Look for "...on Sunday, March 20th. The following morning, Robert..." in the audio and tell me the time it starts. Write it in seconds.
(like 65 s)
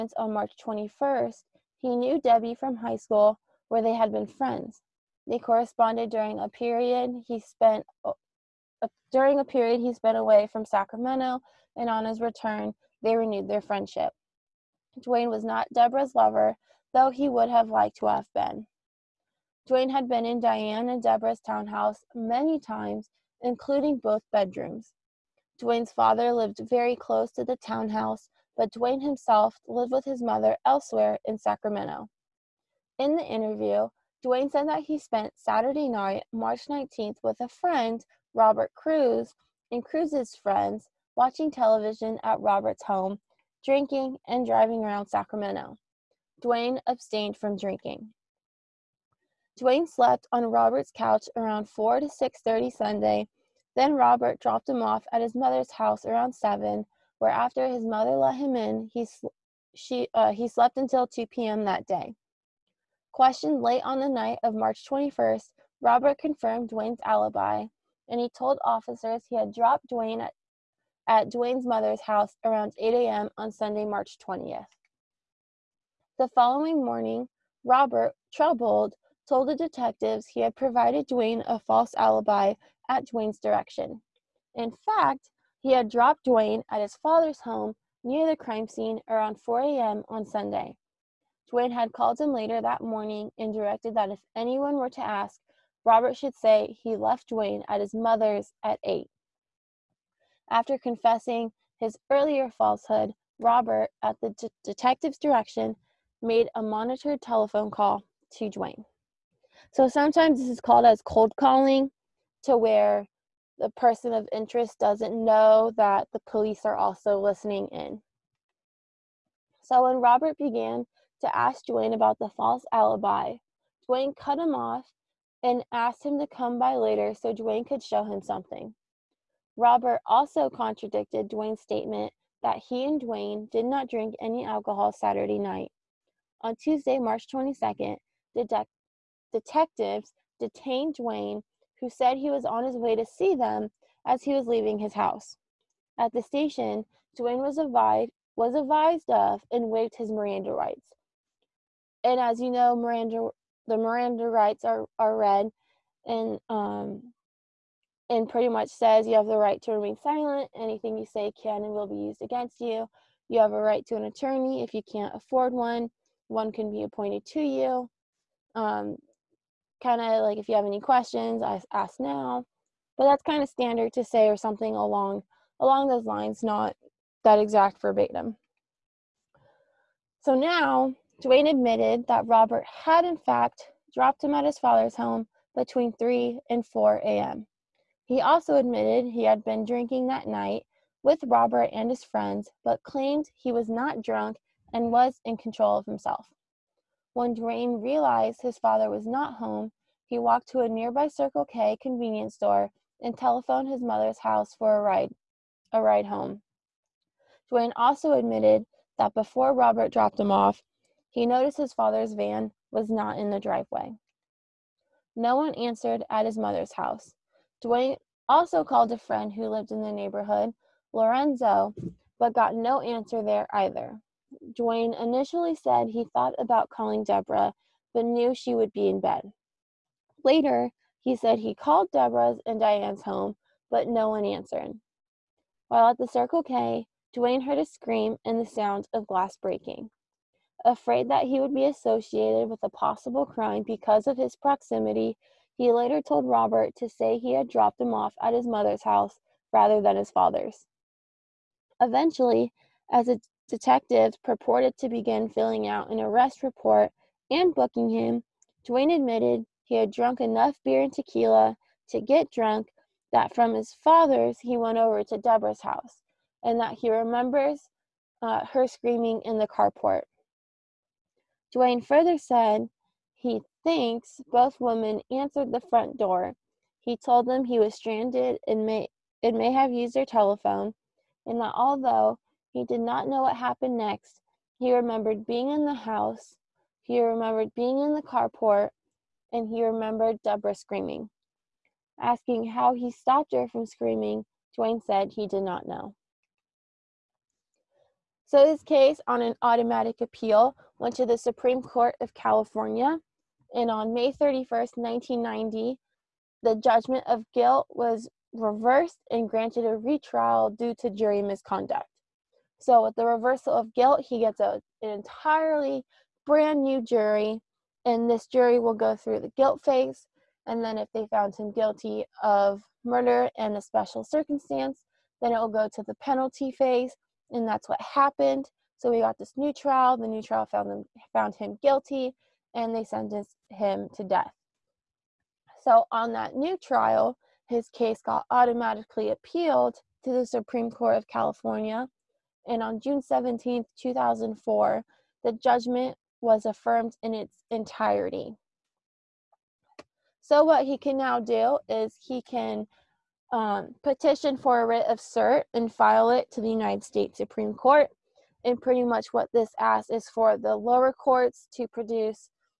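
73 s.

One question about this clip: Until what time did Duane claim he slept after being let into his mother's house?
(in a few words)
2 p.m.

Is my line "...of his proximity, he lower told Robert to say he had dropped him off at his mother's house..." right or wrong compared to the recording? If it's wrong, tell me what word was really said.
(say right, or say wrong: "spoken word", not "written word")
wrong: "later", not "lower".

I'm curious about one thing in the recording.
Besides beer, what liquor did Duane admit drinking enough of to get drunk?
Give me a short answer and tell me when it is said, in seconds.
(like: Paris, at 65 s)
Tequila, at 260 s.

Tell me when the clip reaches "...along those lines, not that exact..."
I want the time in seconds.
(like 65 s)
175 s.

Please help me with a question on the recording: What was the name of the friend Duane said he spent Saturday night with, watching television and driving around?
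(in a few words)
Robert Cruz.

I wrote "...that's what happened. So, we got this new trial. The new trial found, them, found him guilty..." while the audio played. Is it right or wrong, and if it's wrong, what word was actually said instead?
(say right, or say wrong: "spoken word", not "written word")
right.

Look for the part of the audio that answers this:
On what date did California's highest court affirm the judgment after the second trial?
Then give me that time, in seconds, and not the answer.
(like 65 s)
342 s.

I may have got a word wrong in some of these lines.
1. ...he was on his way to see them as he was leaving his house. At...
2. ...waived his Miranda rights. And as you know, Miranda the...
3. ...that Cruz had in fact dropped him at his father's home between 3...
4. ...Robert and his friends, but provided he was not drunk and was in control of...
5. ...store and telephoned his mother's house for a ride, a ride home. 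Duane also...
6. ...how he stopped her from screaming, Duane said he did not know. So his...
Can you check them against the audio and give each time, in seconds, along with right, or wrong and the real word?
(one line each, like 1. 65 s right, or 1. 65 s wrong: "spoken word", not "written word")
1. 142 s right
2. 149 s right
3. 182 s wrong: "Robert", not "Cruz"
4. 191 s wrong: "claimed", not "provided"
5. 202 s right
6. 292 s right.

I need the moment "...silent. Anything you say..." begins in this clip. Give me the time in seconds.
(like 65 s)
160 s.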